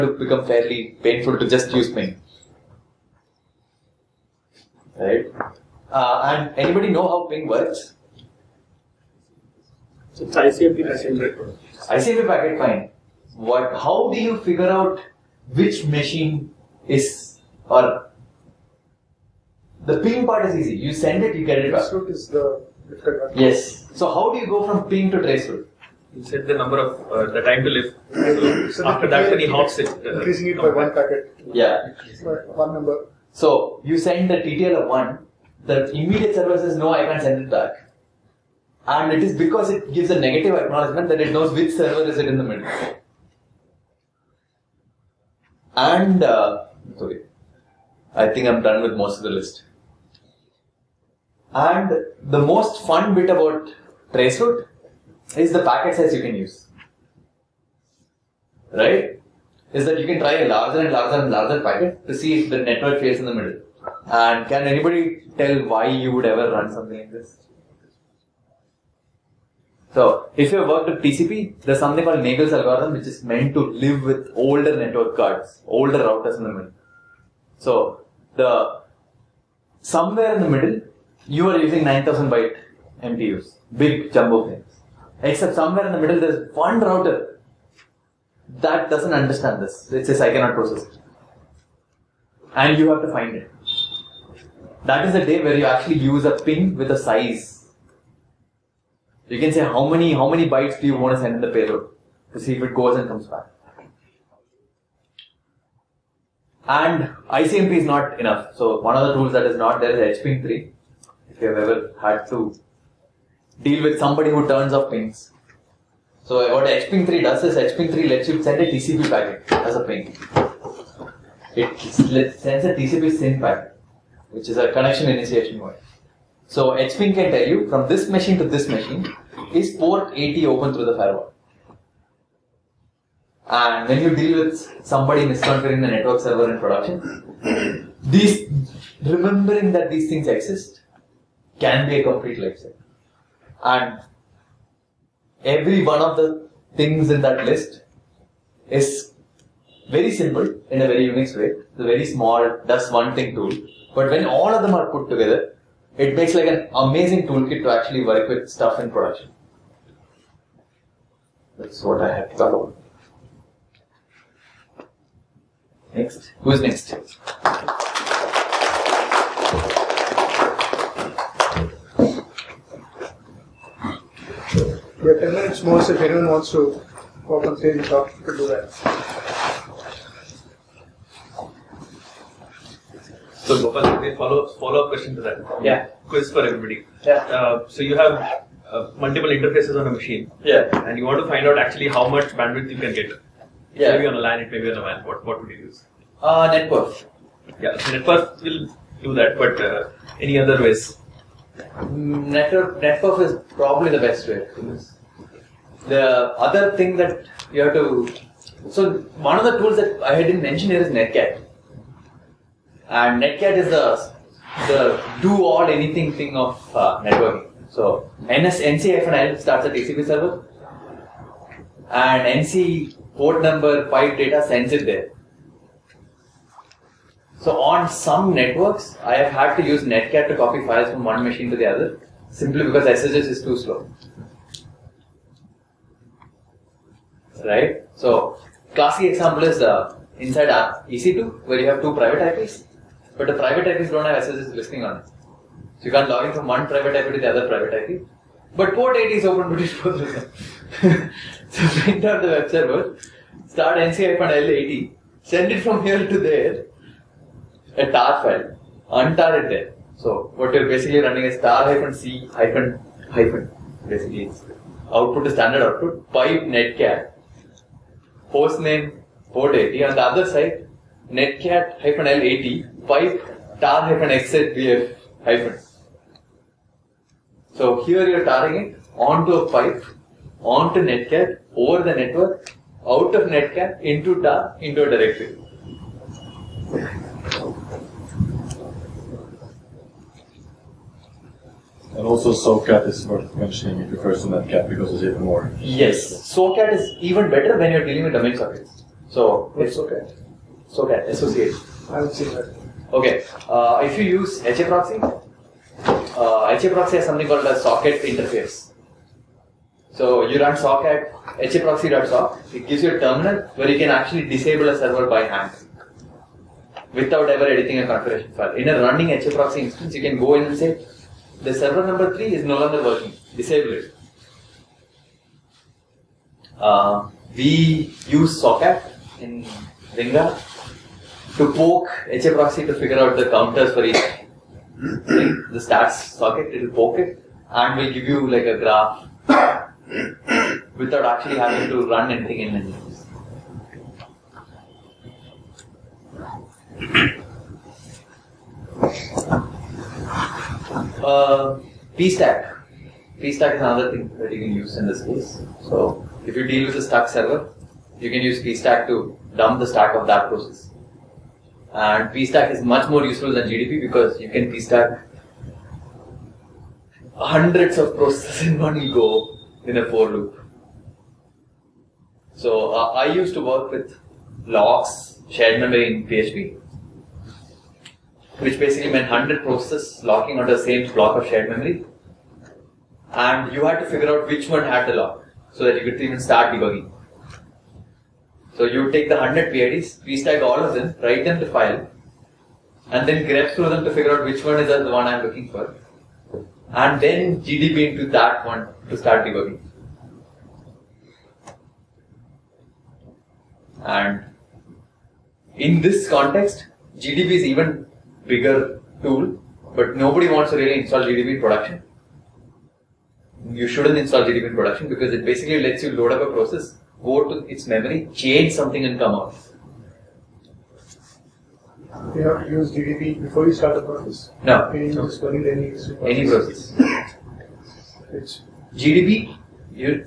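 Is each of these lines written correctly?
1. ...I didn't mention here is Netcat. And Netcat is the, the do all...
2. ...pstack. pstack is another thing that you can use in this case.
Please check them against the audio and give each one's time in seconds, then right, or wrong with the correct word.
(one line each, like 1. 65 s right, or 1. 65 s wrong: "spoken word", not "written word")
1. 210 s right
2. 351 s right.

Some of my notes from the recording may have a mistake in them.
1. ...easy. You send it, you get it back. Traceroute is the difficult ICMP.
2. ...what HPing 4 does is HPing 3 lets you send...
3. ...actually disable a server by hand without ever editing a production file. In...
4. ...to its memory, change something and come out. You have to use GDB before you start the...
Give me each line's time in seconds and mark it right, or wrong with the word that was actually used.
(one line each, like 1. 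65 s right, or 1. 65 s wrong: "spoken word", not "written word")
1. 20 s wrong: "Yes", not "ICMP"
2. 116 s wrong: "3", not "4"
3. 313 s wrong: "configuration", not "production"
4. 417 s right.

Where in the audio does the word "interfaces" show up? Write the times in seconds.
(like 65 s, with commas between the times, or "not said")
189 s, 308 s.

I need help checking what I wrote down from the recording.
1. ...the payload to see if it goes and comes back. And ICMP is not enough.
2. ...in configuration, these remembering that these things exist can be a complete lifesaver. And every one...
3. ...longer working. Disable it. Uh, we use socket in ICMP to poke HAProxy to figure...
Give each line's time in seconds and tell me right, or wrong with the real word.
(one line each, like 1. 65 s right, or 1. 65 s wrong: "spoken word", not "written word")
1. 101 s right
2. 136 s wrong: "production", not "configuration"
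3. 322 s wrong: "Ringa", not "ICMP".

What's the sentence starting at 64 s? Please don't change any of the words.
And can anybody tell why you would ever run something like this?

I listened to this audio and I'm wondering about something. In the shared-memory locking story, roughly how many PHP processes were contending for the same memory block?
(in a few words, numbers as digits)
100.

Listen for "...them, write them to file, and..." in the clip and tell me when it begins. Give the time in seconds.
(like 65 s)
390 s.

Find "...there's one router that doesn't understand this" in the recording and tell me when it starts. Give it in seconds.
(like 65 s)
86 s.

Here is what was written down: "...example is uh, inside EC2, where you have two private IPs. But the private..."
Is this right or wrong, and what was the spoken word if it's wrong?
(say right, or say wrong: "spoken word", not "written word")
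right.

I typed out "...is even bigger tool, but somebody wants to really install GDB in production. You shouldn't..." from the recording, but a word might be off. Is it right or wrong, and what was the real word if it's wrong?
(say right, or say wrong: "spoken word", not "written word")
wrong: "nobody", not "somebody".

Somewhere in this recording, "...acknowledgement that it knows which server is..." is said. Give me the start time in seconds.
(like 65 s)
40 s.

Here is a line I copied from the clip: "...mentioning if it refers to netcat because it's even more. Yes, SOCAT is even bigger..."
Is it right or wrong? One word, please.
wrong.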